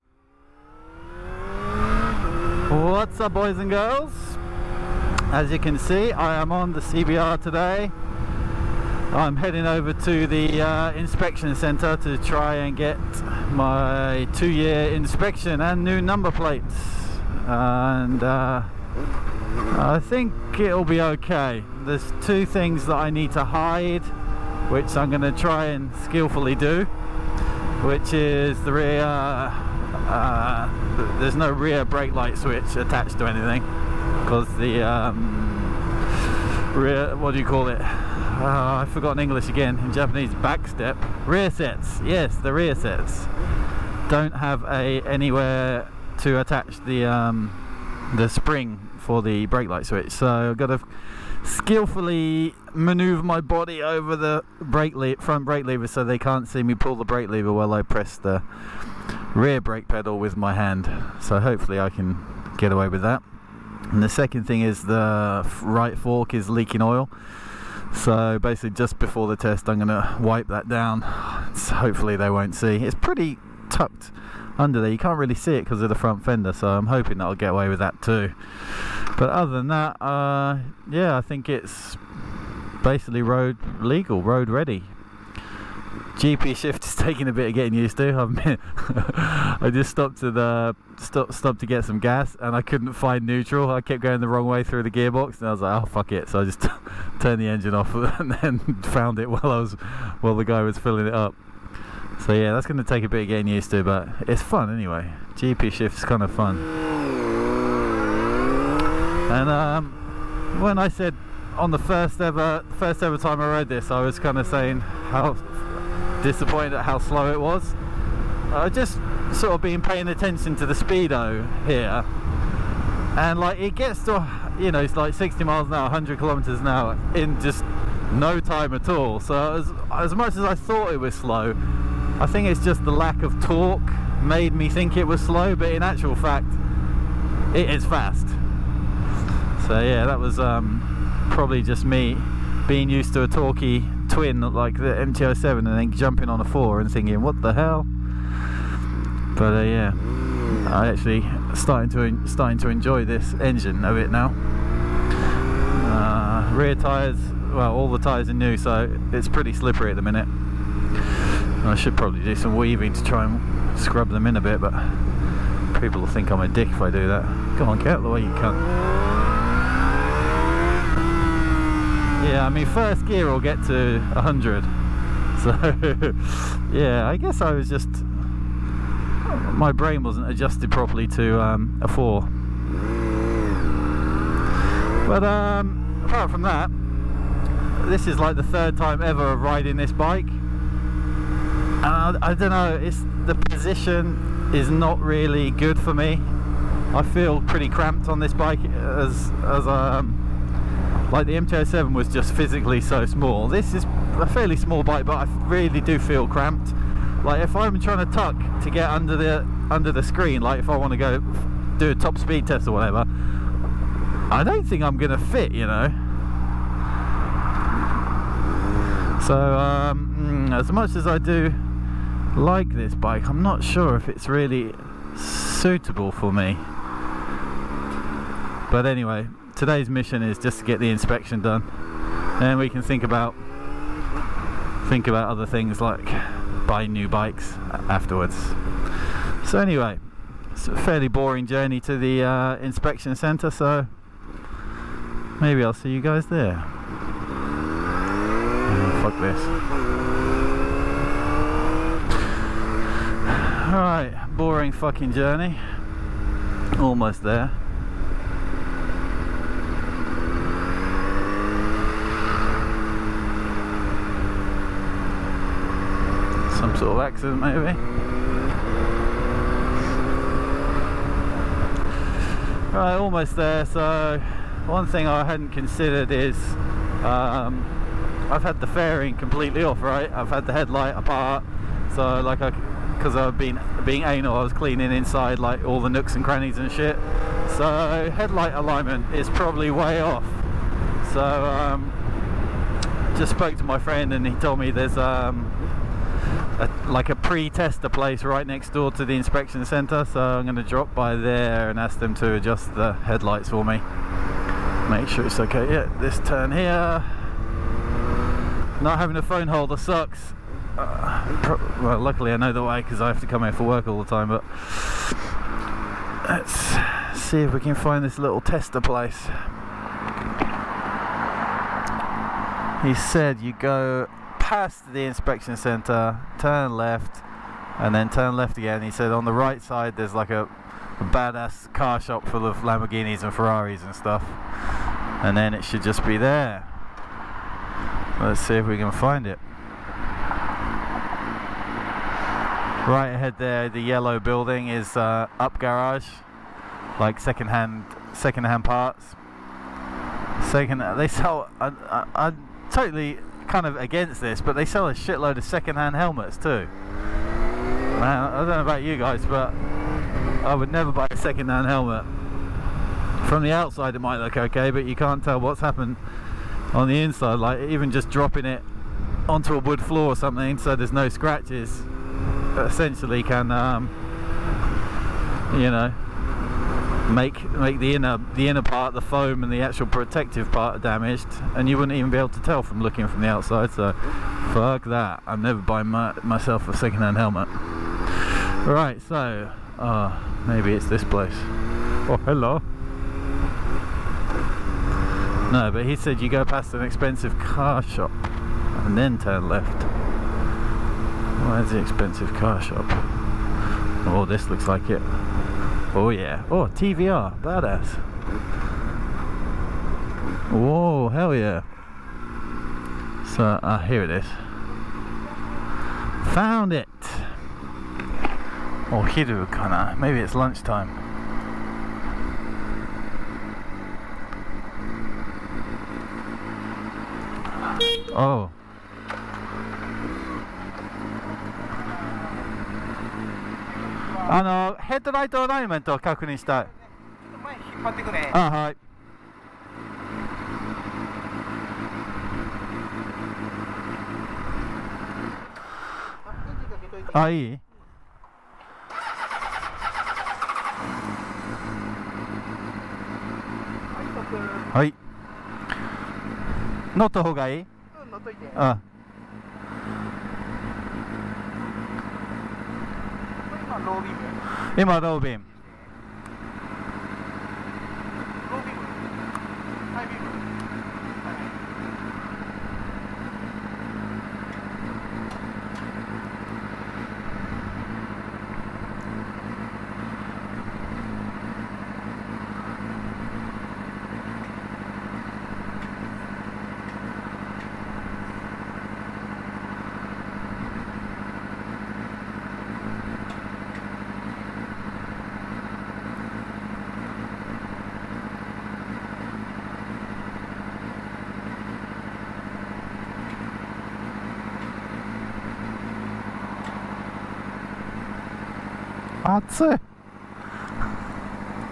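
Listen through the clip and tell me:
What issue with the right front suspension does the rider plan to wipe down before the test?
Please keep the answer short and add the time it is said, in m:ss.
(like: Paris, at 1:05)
Leaking oil, at 1:06.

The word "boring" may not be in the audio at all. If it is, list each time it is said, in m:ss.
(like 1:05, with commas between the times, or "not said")
4:01, 4:14.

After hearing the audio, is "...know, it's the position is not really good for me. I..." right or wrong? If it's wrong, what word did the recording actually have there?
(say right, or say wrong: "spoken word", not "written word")
right.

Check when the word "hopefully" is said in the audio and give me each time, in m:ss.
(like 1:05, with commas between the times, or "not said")
1:01, 1:11.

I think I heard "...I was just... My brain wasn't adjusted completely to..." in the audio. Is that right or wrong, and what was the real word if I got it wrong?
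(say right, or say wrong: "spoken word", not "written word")
wrong: "properly", not "completely".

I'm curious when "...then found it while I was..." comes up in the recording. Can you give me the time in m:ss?
1:38.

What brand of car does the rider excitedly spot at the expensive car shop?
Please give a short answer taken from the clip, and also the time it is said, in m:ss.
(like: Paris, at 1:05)
TVR, at 6:46.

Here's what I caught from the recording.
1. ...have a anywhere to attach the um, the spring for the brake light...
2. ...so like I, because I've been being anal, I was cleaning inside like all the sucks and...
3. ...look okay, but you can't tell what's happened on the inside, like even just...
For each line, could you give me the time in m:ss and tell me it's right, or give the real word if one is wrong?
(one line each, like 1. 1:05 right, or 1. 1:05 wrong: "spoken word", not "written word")
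1. 0:44 right
2. 4:41 wrong: "nooks", not "sucks"
3. 6:04 right.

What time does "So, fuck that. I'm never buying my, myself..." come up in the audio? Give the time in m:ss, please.
6:23.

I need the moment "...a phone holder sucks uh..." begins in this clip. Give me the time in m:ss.
5:09.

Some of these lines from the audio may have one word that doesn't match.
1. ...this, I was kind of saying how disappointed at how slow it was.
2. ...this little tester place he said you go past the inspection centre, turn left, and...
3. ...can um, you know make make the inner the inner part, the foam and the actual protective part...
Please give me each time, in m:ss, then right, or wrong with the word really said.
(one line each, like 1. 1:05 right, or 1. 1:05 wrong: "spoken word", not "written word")
1. 1:53 right
2. 5:18 right
3. 6:13 right.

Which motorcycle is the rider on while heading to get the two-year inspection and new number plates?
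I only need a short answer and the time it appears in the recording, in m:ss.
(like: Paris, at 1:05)
CBR, at 0:06.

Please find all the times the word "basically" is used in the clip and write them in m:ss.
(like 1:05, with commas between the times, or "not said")
1:08, 1:22.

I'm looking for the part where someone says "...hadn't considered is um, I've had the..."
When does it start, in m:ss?
4:35.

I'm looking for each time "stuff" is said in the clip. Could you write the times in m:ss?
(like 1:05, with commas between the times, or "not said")
5:33.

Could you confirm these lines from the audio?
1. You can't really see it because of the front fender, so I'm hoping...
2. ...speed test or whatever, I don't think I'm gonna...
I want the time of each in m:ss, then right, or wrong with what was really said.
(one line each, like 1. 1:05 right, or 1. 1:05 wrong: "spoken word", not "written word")
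1. 1:14 right
2. 3:32 right.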